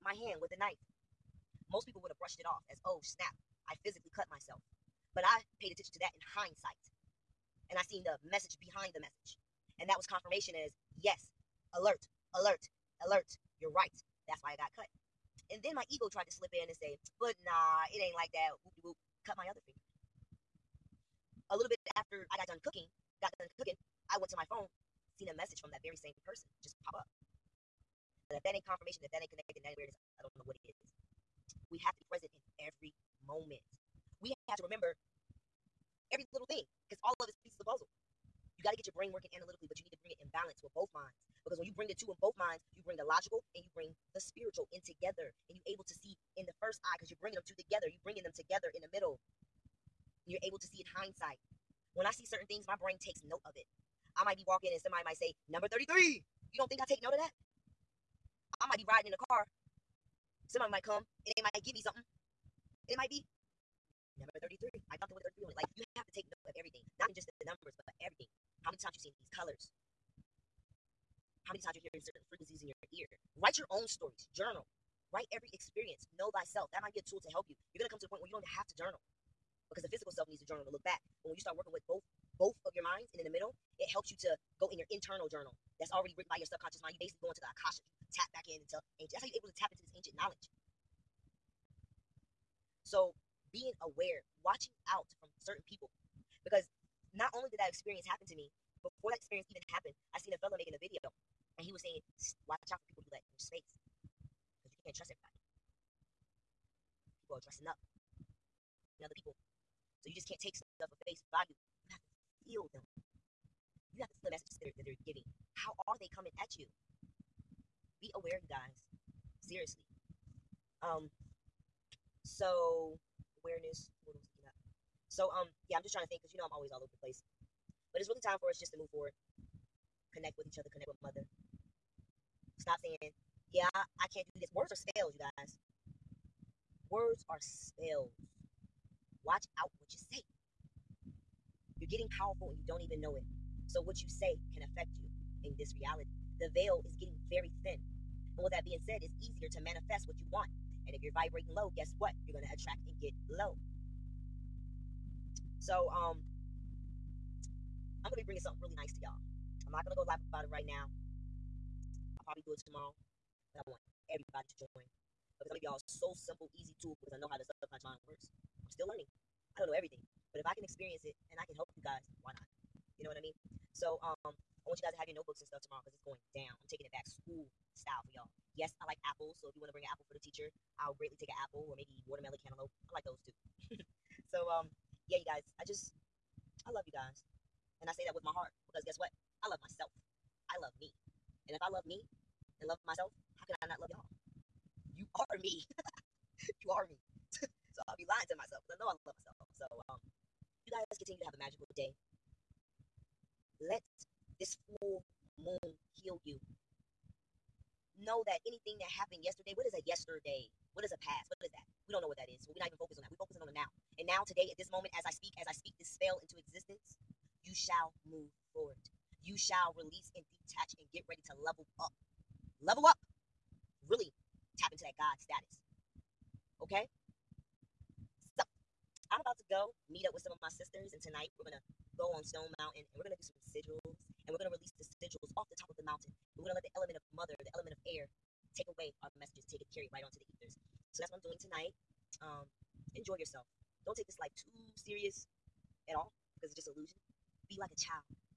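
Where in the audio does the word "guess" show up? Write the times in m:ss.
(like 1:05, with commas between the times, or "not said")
2:31, 3:08.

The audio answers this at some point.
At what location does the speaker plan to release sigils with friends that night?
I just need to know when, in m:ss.
3:52.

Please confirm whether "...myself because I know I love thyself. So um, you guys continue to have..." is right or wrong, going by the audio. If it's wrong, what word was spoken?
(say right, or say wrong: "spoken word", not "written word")
wrong: "myself", not "thyself".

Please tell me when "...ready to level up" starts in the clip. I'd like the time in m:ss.
3:41.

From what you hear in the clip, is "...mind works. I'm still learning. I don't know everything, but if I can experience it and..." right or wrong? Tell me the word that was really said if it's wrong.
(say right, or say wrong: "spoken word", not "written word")
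right.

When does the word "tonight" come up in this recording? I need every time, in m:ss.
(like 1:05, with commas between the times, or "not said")
3:50, 4:01.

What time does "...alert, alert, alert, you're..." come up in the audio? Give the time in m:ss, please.
0:11.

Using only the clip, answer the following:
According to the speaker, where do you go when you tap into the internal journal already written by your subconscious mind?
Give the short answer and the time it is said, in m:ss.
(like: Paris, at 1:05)
The Akasha, at 1:27.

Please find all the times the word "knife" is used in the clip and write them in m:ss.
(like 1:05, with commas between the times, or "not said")
0:00.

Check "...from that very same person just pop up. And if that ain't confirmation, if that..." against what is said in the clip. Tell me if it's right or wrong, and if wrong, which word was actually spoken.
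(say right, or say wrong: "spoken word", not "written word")
right.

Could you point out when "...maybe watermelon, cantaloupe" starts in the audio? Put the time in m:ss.
3:01.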